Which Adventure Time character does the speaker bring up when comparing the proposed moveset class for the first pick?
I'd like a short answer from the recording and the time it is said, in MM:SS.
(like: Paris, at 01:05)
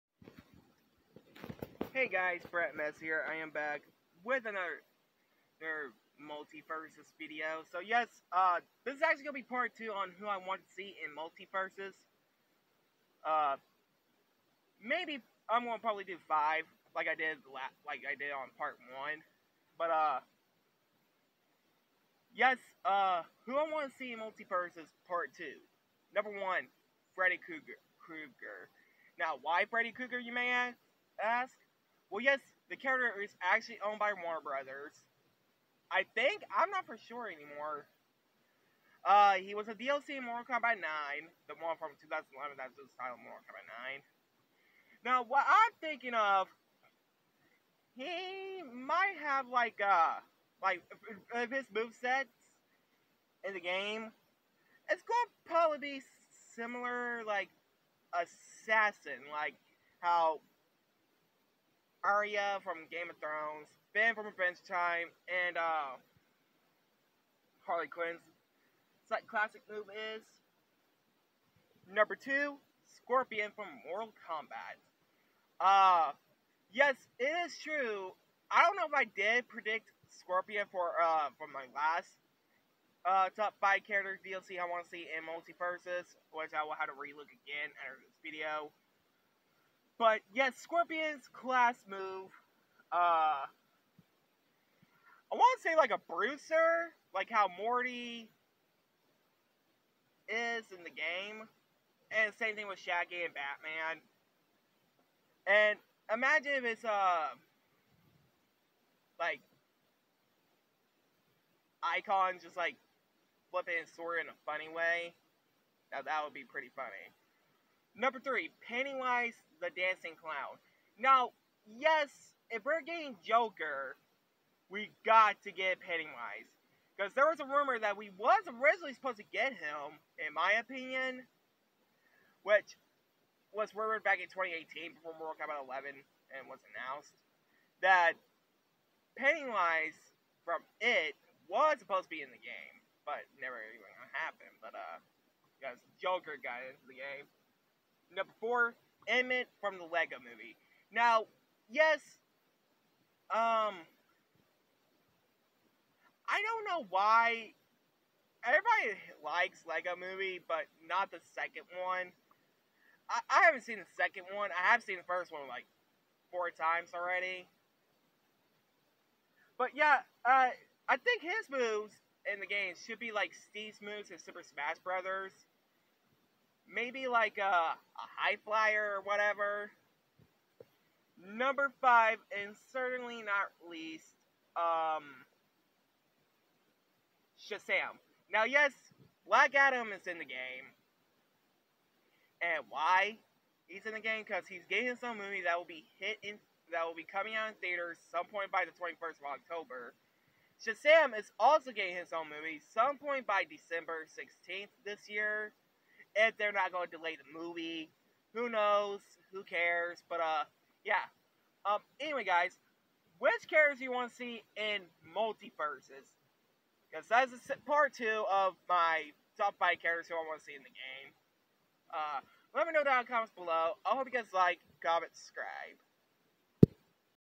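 Finn, at 01:03.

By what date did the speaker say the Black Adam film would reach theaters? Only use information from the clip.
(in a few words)
21st of October.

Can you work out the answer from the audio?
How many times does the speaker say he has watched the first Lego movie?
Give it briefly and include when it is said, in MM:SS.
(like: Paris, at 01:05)
4, at 02:46.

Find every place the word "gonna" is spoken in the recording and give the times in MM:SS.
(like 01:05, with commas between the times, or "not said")
00:09, 00:15.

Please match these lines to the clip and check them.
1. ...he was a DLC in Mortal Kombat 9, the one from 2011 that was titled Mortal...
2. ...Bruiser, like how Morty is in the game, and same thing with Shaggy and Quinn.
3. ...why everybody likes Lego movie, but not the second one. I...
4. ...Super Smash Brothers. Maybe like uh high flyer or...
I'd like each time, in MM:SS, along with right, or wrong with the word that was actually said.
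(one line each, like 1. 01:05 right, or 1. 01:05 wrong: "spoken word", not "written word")
1. 00:39 right
2. 01:36 wrong: "Batman", not "Quinn"
3. 02:36 right
4. 02:54 right.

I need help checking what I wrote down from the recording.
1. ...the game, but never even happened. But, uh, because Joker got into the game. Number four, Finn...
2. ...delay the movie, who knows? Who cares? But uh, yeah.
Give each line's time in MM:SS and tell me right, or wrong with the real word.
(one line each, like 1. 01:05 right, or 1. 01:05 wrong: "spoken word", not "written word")
1. 02:22 wrong: "Emmett", not "Finn"
2. 03:26 right.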